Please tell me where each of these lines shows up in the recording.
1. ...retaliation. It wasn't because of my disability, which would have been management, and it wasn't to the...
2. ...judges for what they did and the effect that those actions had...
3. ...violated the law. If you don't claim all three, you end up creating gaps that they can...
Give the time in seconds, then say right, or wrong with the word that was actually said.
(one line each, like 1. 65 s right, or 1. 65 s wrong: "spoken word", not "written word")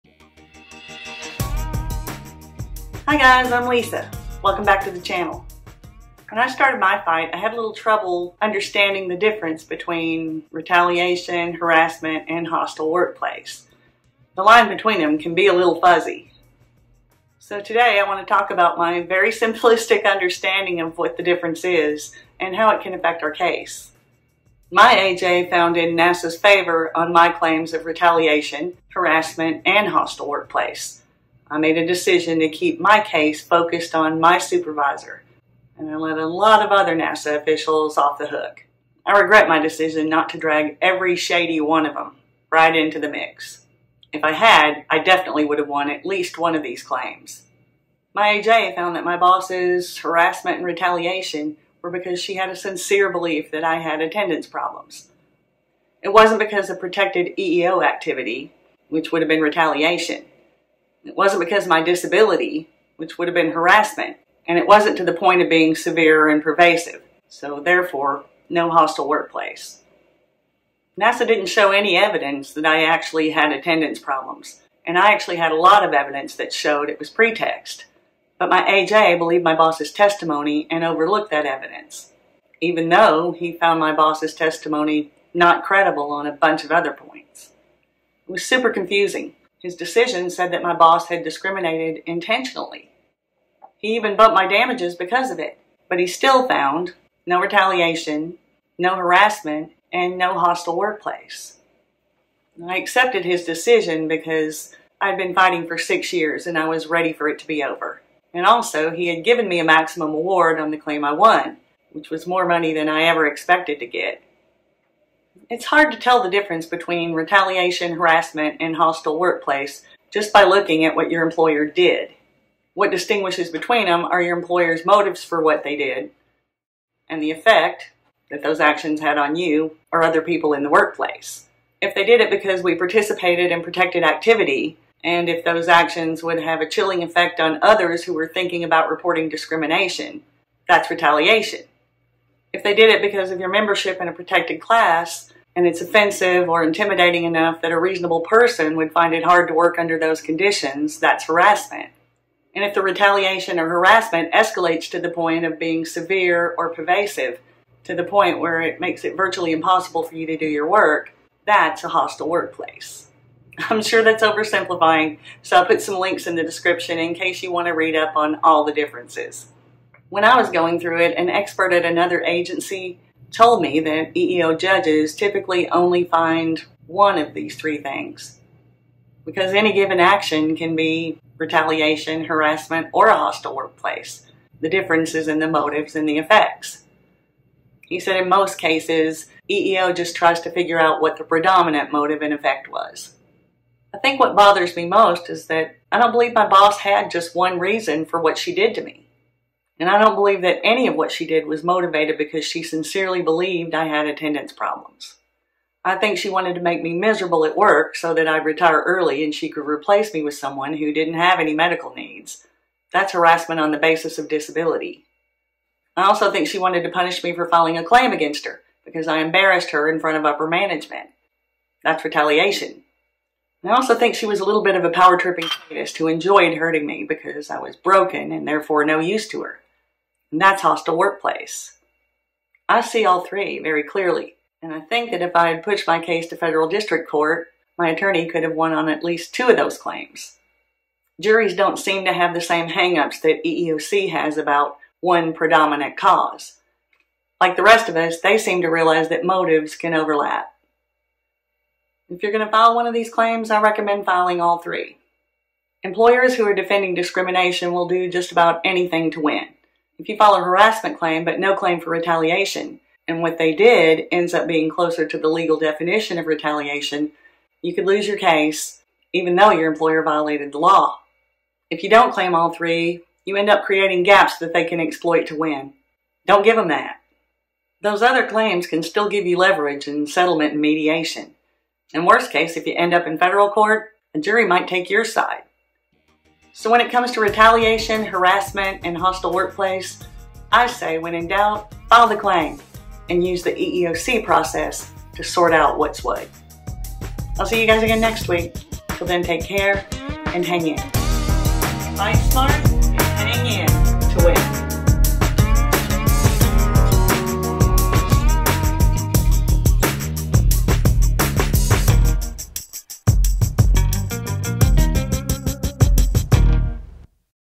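1. 59 s wrong: "harassment", not "management"
2. 124 s wrong: "motives", not "judges"
3. 270 s right.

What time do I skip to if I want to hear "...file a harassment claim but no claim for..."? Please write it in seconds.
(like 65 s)
260 s.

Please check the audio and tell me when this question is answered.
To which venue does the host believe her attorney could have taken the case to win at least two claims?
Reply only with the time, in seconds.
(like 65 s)
236 s.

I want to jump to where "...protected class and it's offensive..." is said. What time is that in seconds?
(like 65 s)
144 s.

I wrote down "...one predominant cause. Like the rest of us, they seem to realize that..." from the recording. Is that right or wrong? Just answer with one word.
right.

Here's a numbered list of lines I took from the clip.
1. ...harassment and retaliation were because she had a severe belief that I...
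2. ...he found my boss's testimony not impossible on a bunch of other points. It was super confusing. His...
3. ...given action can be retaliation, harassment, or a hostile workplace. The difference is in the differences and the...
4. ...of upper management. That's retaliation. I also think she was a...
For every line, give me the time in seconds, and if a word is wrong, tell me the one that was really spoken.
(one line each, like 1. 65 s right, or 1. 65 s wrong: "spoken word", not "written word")
1. 49 s wrong: "sincere", not "severe"
2. 83 s wrong: "credible", not "impossible"
3. 179 s wrong: "motives", not "differences"
4. 220 s right.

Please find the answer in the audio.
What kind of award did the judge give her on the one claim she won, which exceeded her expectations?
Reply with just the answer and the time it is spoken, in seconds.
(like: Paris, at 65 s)
maximum award, at 109 s.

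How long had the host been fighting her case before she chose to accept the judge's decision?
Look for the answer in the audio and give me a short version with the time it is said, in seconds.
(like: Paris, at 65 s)
6 years, at 105 s.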